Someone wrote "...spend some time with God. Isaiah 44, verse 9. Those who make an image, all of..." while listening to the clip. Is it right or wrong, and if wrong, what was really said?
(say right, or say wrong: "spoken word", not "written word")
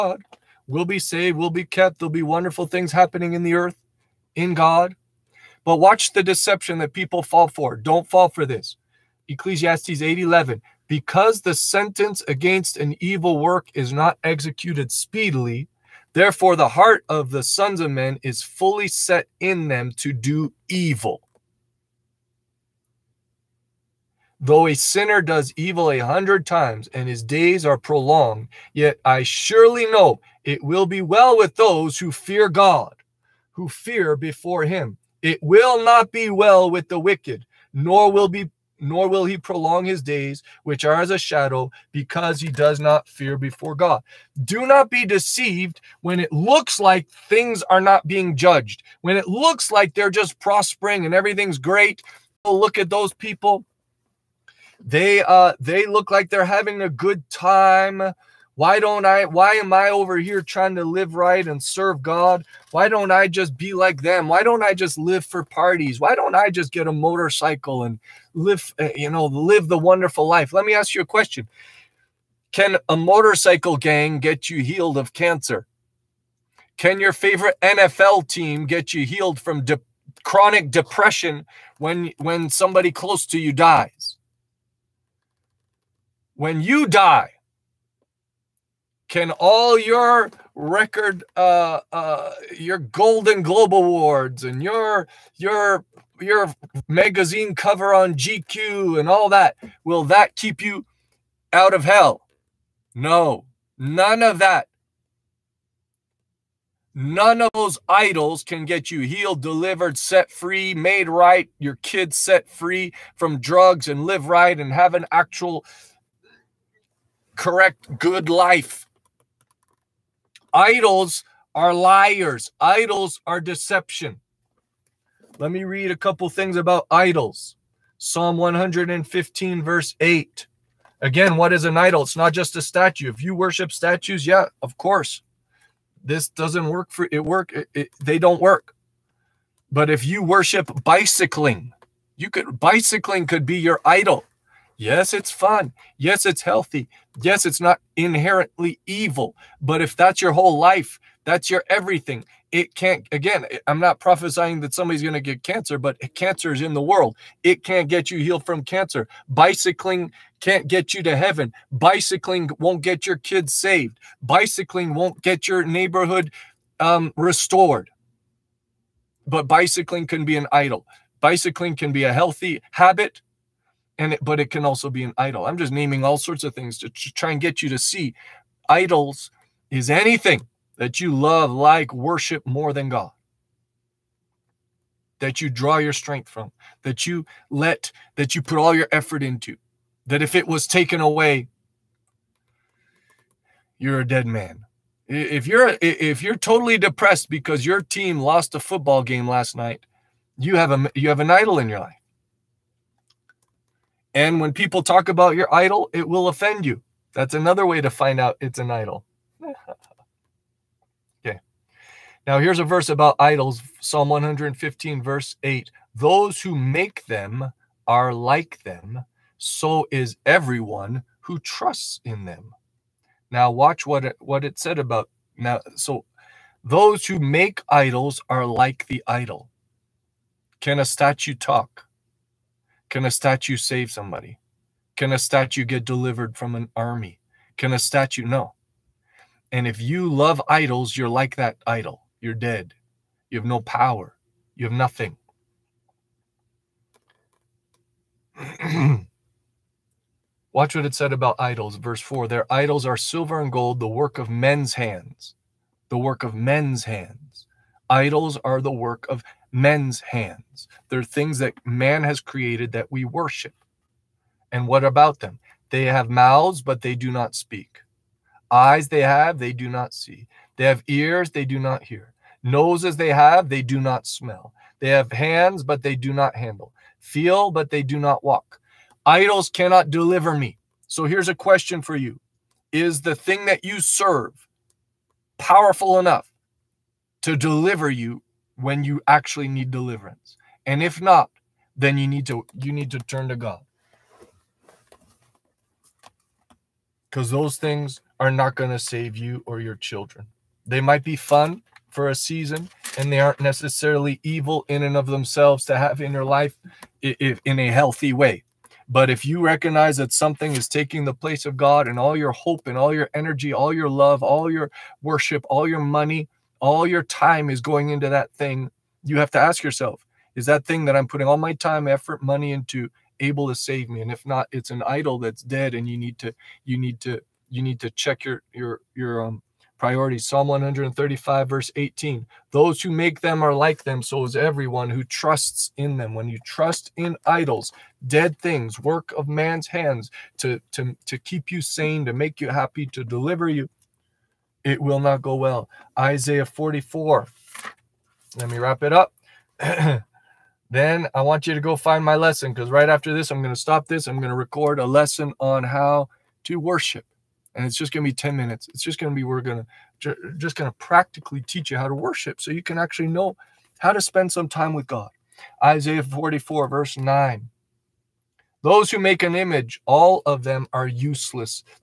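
right.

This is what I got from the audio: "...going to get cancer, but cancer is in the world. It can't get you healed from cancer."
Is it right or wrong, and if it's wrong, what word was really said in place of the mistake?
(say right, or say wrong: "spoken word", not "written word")
right.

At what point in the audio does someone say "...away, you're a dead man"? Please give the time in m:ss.
3:11.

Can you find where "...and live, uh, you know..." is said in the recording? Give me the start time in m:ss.
1:07.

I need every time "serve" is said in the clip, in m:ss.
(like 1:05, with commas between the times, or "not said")
1:01, 4:43.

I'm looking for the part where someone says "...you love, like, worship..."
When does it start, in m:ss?
3:01.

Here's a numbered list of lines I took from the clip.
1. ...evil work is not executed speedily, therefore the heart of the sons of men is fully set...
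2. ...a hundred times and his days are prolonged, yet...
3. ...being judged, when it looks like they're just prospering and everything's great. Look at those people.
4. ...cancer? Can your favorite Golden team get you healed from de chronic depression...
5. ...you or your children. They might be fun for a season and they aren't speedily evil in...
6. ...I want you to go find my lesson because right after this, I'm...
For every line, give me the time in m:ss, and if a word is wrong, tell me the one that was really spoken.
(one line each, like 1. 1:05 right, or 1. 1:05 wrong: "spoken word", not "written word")
1. 0:12 right
2. 0:25 right
3. 0:48 right
4. 1:15 wrong: "NFL", not "Golden"
5. 4:59 wrong: "necessarily", not "speedily"
6. 5:51 right.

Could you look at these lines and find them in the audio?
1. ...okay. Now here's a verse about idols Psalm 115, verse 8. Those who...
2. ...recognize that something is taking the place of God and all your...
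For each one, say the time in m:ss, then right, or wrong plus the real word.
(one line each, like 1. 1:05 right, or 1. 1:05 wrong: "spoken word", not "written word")
1. 3:31 right
2. 5:09 right.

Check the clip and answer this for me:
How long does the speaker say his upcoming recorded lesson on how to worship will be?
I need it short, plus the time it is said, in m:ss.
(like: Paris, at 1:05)
10 minutes, at 5:58.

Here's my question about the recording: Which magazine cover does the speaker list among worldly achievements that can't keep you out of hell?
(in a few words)
GQ.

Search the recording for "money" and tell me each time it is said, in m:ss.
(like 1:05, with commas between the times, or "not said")
5:15, 5:22.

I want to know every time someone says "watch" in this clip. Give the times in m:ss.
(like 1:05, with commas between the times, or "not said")
0:05, 3:43, 4:10.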